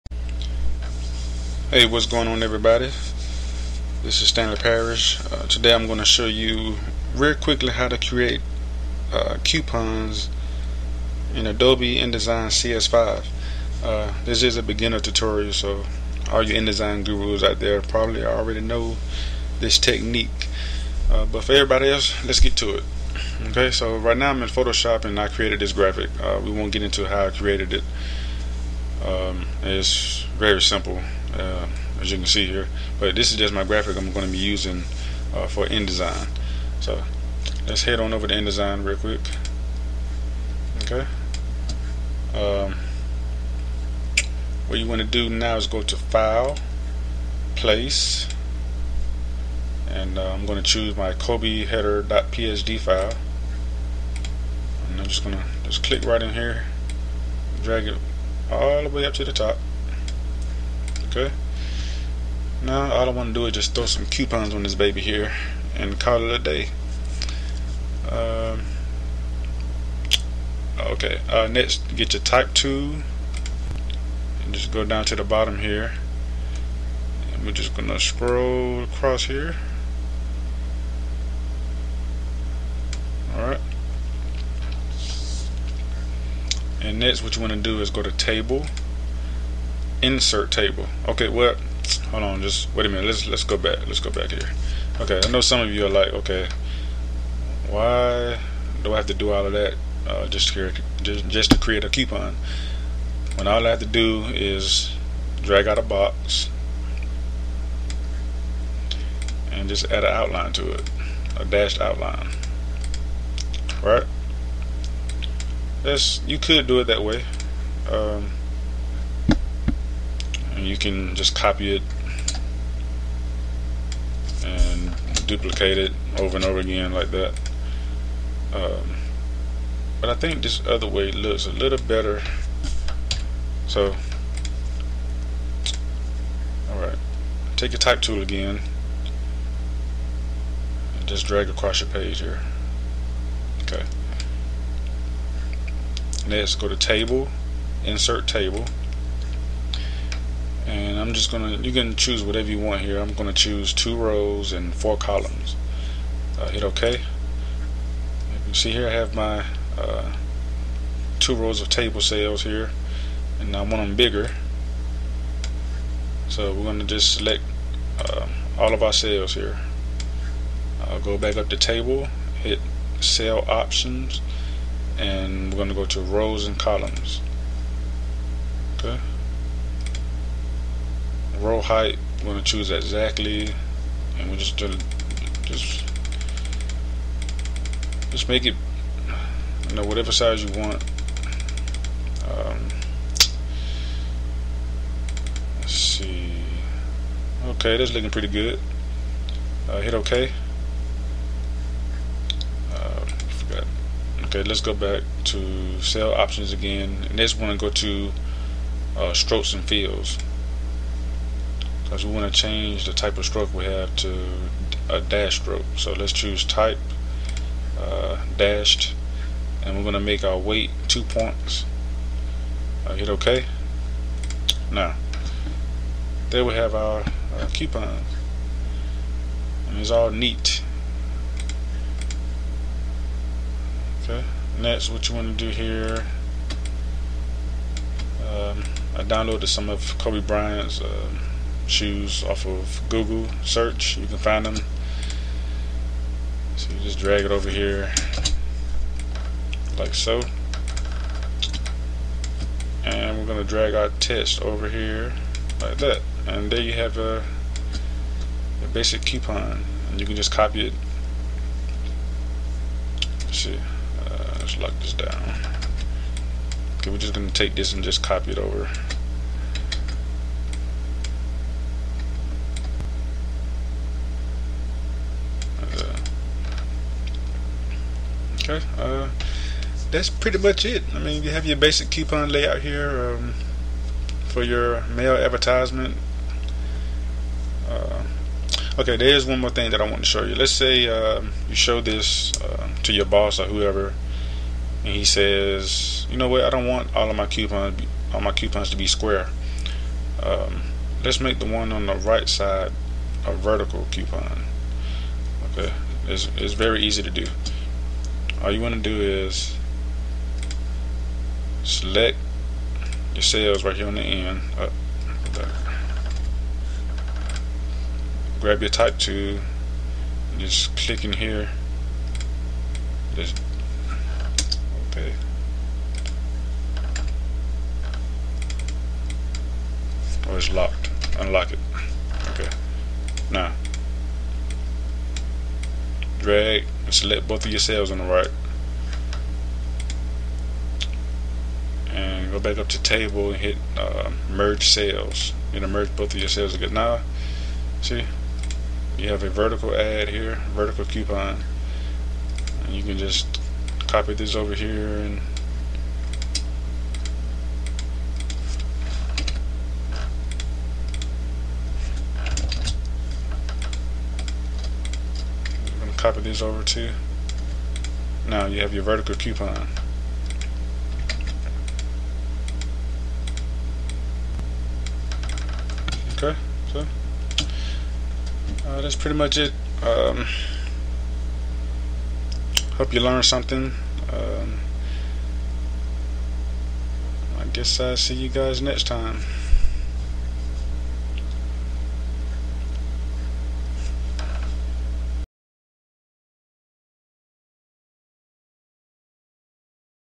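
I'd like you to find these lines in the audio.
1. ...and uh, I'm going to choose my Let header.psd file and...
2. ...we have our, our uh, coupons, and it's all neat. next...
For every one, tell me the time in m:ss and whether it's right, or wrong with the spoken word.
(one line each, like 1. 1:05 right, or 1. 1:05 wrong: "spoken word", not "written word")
1. 0:49 wrong: "Kobe", not "Let"
2. 3:46 right.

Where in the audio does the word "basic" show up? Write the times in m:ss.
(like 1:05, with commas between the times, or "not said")
4:18, 4:41.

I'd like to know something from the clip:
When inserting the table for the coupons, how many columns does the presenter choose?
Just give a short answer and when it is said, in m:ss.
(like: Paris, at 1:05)
4, at 2:34.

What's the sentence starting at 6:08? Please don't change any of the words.
Now you have your vertical coupon.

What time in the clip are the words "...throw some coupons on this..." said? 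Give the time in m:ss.
1:03.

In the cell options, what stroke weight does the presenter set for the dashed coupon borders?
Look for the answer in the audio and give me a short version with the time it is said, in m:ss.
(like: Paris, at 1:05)
2 points, at 3:40.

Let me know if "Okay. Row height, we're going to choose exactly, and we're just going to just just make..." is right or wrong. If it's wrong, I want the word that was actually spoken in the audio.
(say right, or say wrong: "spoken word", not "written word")
right.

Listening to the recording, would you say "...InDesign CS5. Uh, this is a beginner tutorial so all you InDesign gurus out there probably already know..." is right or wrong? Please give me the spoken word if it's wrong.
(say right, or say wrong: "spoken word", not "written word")
right.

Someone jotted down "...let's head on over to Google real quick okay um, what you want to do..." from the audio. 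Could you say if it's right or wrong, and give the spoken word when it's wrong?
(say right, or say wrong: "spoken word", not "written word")
wrong: "InDesign", not "Google".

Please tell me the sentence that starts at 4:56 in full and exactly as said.
I don't want all of my coupons, all my coupons to be square.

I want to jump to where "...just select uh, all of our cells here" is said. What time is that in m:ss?
2:46.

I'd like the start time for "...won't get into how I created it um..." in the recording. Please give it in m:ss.
0:26.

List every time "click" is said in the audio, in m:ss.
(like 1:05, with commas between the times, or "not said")
0:55, 5:20.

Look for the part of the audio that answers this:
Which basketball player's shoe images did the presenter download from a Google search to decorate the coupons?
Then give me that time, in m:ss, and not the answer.
3:59.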